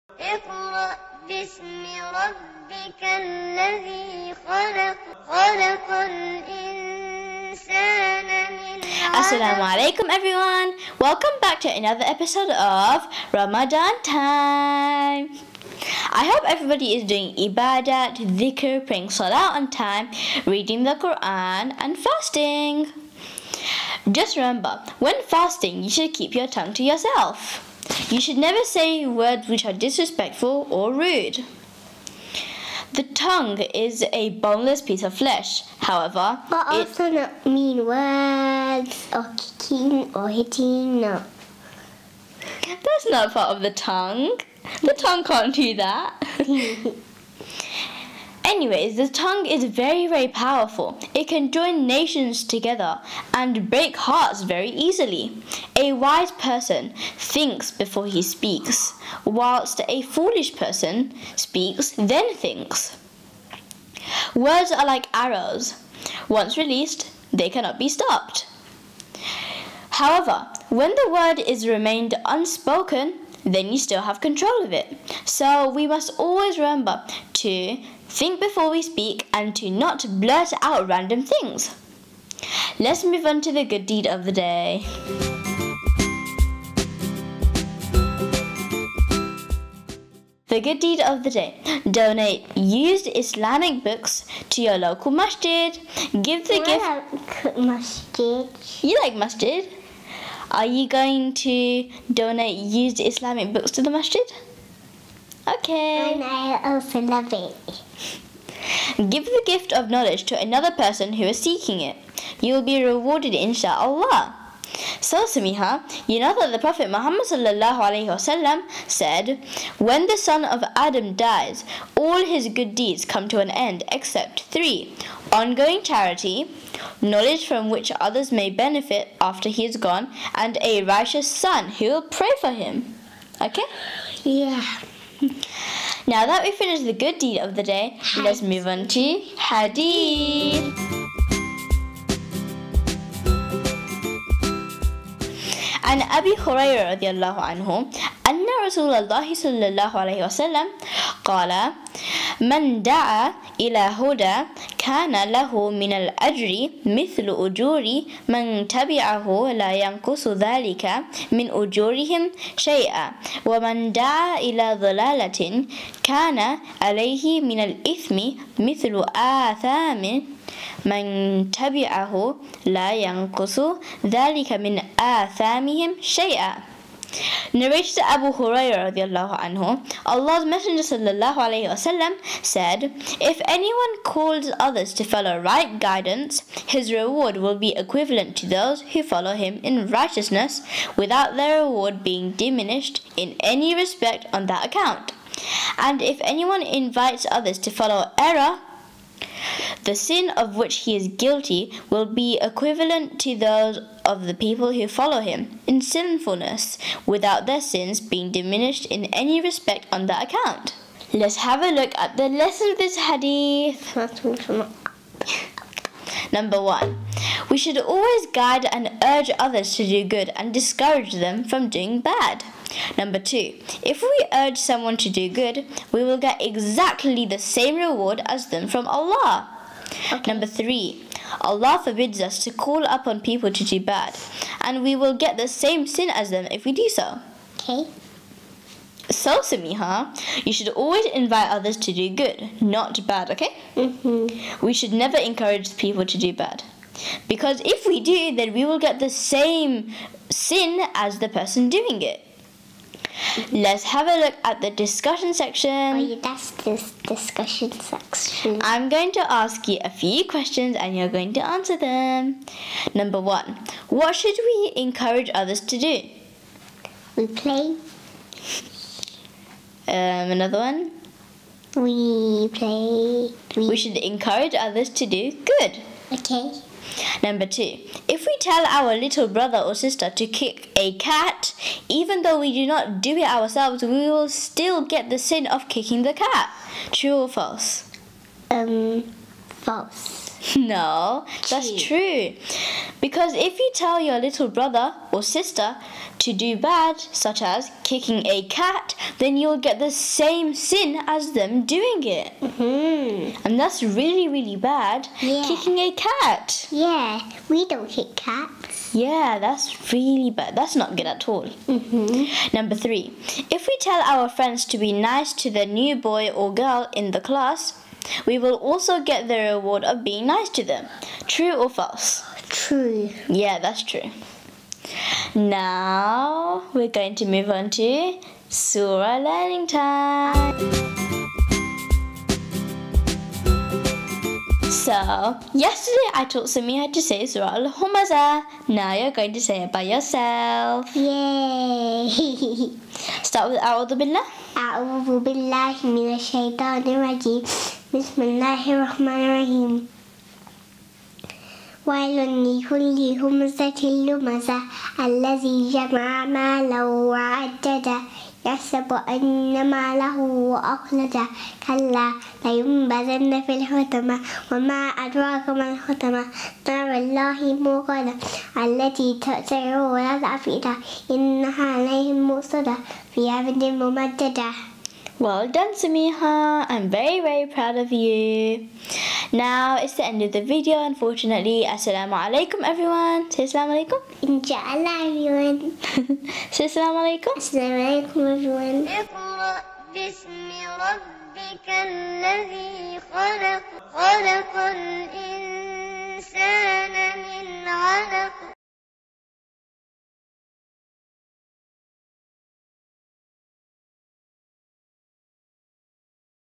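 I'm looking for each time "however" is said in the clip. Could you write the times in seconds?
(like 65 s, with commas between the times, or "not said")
35 s, 70 s.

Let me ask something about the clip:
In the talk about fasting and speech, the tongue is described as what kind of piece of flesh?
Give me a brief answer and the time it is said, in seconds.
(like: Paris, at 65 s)
boneless, at 34 s.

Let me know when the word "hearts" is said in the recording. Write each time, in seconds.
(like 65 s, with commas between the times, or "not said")
53 s.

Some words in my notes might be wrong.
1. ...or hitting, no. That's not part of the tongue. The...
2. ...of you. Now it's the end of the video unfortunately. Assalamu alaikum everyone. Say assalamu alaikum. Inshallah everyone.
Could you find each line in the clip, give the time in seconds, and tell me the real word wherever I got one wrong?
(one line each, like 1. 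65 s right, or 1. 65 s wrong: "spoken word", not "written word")
1. 40 s right
2. 377 s right.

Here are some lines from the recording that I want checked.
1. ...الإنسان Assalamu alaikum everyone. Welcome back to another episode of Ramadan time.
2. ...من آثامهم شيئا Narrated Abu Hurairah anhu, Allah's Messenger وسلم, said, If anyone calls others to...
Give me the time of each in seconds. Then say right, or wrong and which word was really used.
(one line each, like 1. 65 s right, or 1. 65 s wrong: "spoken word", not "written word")
1. 5 s right
2. 174 s right.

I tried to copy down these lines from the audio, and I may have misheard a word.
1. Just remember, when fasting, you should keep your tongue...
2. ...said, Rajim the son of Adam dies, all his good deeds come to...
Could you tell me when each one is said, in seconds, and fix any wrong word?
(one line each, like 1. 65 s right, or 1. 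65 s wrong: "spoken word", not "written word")
1. 24 s right
2. 118 s wrong: "When", not "Rajim".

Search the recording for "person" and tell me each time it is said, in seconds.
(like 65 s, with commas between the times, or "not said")
56 s, 60 s, 110 s, 251 s.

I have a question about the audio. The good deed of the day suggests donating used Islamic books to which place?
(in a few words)
your local masjid.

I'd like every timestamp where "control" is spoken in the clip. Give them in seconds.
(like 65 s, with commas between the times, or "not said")
74 s.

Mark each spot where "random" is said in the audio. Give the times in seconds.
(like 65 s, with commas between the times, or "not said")
80 s.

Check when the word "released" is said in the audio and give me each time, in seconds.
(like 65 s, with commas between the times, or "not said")
66 s.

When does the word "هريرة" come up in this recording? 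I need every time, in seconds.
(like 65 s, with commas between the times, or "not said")
146 s.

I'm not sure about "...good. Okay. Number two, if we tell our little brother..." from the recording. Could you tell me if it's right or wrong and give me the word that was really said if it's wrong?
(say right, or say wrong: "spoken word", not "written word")
right.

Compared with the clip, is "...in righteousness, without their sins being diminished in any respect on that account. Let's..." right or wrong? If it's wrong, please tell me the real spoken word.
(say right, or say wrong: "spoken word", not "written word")
wrong: "sinfulness", not "righteousness".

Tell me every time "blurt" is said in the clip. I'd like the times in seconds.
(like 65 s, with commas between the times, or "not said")
80 s.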